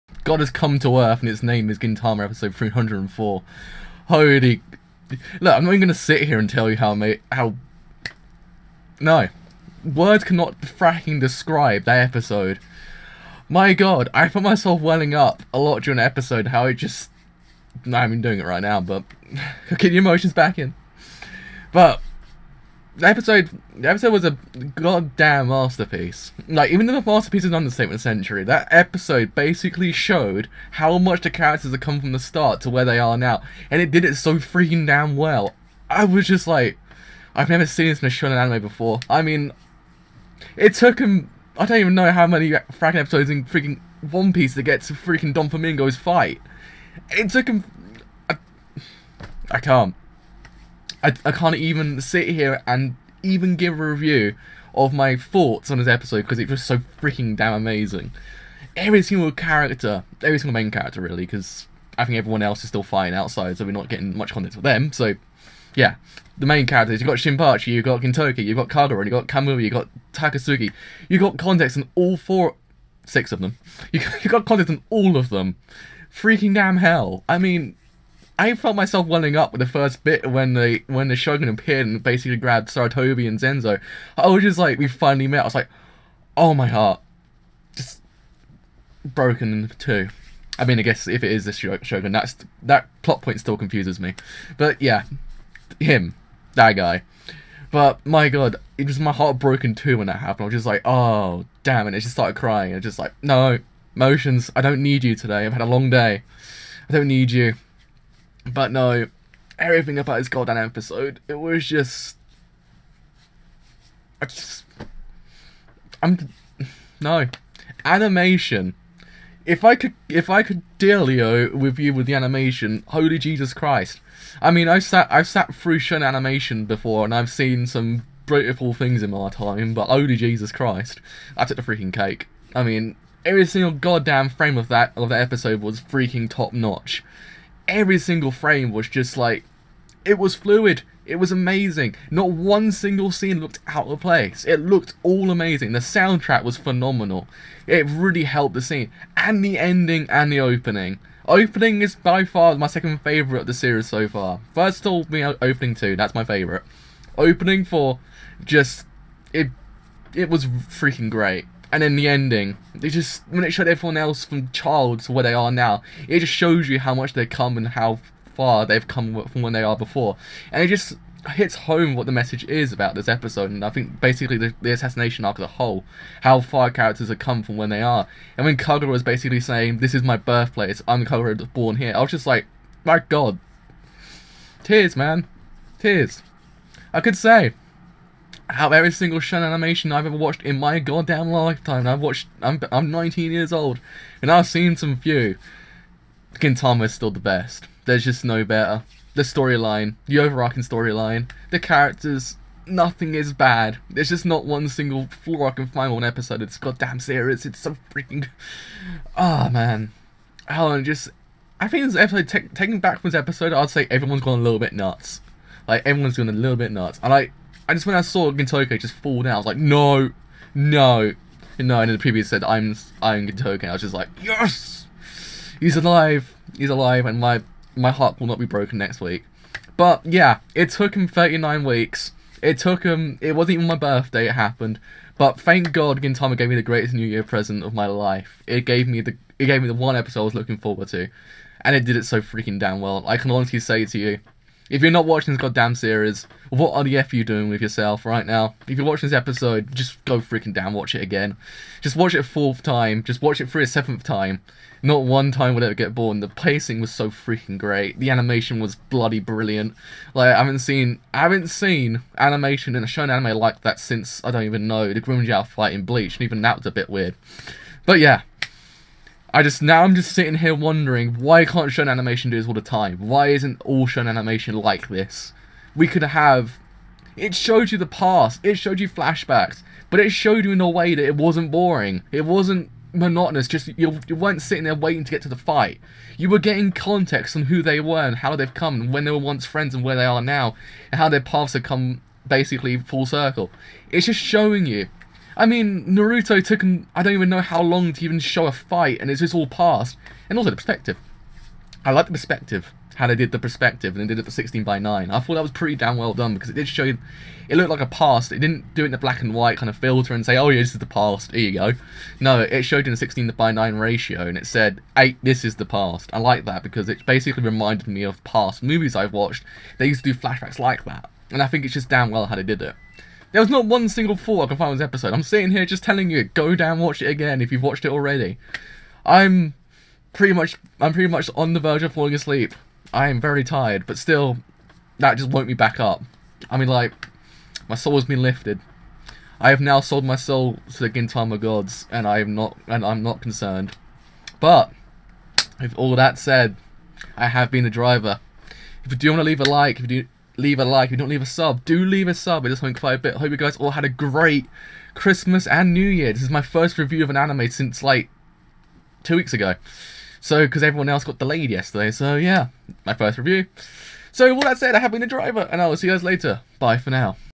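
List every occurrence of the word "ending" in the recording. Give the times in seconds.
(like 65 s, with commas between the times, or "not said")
149 s, 162 s.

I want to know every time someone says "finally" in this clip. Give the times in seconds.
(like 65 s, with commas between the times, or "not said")
84 s.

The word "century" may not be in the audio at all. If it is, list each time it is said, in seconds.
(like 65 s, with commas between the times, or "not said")
28 s.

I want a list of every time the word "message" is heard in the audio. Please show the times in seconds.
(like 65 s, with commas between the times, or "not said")
172 s.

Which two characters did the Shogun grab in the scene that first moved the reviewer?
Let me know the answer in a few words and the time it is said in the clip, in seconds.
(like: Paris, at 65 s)
Sarutobi and Zenzo, at 82 s.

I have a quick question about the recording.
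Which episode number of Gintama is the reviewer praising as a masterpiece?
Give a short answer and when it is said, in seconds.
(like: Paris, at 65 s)
304, at 1 s.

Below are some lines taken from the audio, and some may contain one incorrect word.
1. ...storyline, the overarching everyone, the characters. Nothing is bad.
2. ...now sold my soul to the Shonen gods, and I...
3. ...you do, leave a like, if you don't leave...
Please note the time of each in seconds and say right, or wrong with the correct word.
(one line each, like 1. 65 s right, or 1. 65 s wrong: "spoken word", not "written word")
1. 199 s wrong: "storyline", not "everyone"
2. 339 s wrong: "Gintama", not "Shonen"
3. 349 s right.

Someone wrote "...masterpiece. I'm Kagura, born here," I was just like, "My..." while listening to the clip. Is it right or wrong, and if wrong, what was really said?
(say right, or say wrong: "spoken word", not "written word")
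wrong: "birthplace", not "masterpiece".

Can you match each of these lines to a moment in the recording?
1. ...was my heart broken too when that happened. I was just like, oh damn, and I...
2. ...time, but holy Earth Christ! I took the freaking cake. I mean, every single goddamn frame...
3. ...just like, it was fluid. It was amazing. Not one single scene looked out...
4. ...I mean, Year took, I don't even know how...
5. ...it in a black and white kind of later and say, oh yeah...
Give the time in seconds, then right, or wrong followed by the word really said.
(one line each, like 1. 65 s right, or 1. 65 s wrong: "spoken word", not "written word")
1. 98 s right
2. 129 s wrong: "Jesus", not "Earth"
3. 138 s right
4. 295 s wrong: "Naruto", not "Year"
5. 308 s wrong: "filter", not "later".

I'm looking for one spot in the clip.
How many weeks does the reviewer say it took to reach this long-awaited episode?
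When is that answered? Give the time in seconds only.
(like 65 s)
231 s.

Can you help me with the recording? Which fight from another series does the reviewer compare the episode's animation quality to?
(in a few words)
the Grimmjow fight in Bleach.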